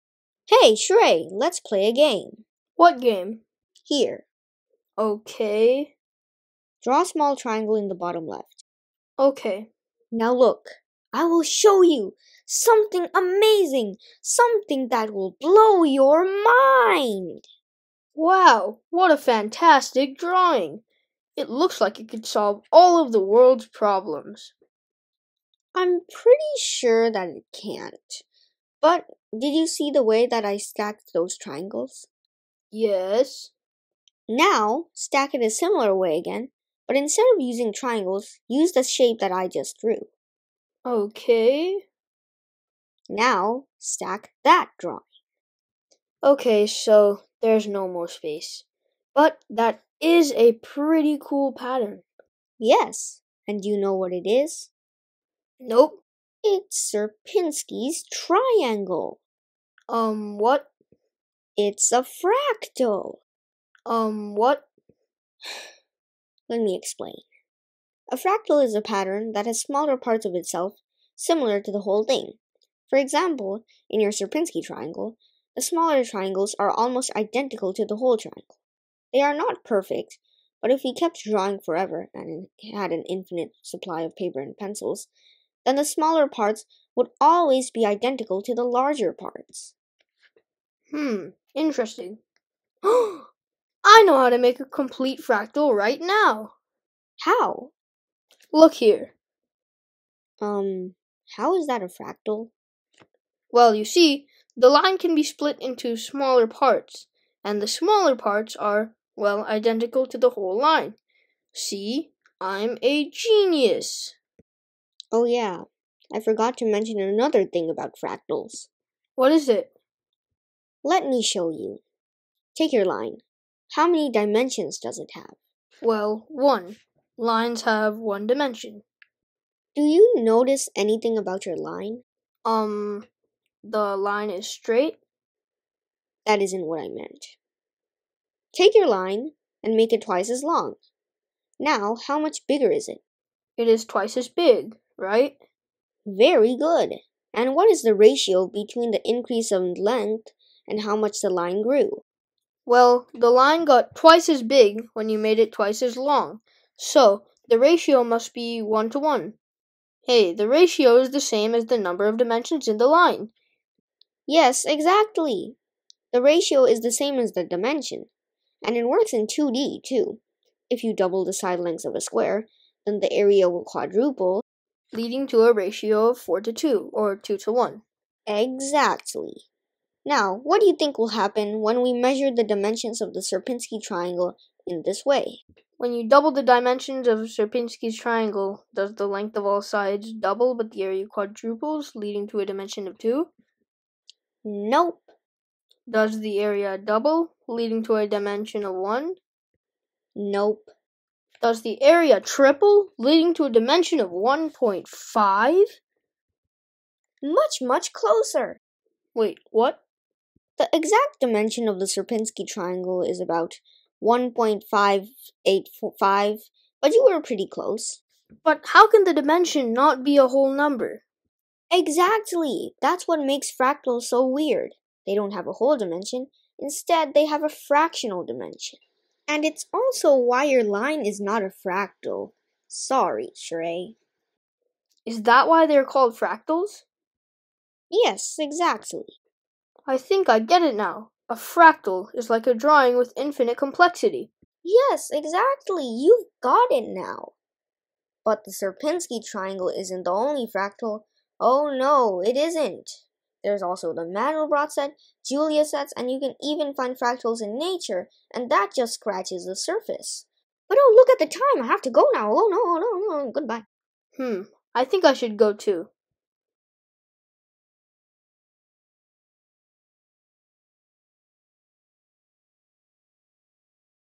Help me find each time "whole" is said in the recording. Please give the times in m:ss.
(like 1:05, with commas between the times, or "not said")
1:11, 1:17, 1:50, 3:40, 3:45.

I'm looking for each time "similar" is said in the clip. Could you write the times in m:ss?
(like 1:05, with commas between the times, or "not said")
0:35, 1:11.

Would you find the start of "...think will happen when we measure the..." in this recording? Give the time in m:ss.
3:00.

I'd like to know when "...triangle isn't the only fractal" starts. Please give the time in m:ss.
4:09.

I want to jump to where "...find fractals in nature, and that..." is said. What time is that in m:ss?
4:16.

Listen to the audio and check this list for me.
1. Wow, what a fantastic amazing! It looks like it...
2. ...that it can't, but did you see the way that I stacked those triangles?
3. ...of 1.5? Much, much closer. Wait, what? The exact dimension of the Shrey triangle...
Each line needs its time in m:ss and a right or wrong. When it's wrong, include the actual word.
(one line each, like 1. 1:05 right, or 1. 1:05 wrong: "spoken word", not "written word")
1. 0:18 wrong: "drawing", not "amazing"
2. 0:27 right
3. 3:23 wrong: "Sierpinski", not "Shrey".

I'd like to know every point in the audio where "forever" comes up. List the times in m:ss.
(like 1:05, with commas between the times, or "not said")
1:21.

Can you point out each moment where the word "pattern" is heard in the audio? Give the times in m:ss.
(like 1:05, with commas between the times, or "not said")
0:51, 1:08.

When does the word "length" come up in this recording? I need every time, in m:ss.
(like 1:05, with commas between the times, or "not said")
2:29, 2:51, 3:09.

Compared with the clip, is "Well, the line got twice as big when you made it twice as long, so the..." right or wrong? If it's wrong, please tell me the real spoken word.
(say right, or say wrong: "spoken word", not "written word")
right.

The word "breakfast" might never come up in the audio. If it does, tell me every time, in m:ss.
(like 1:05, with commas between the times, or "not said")
not said.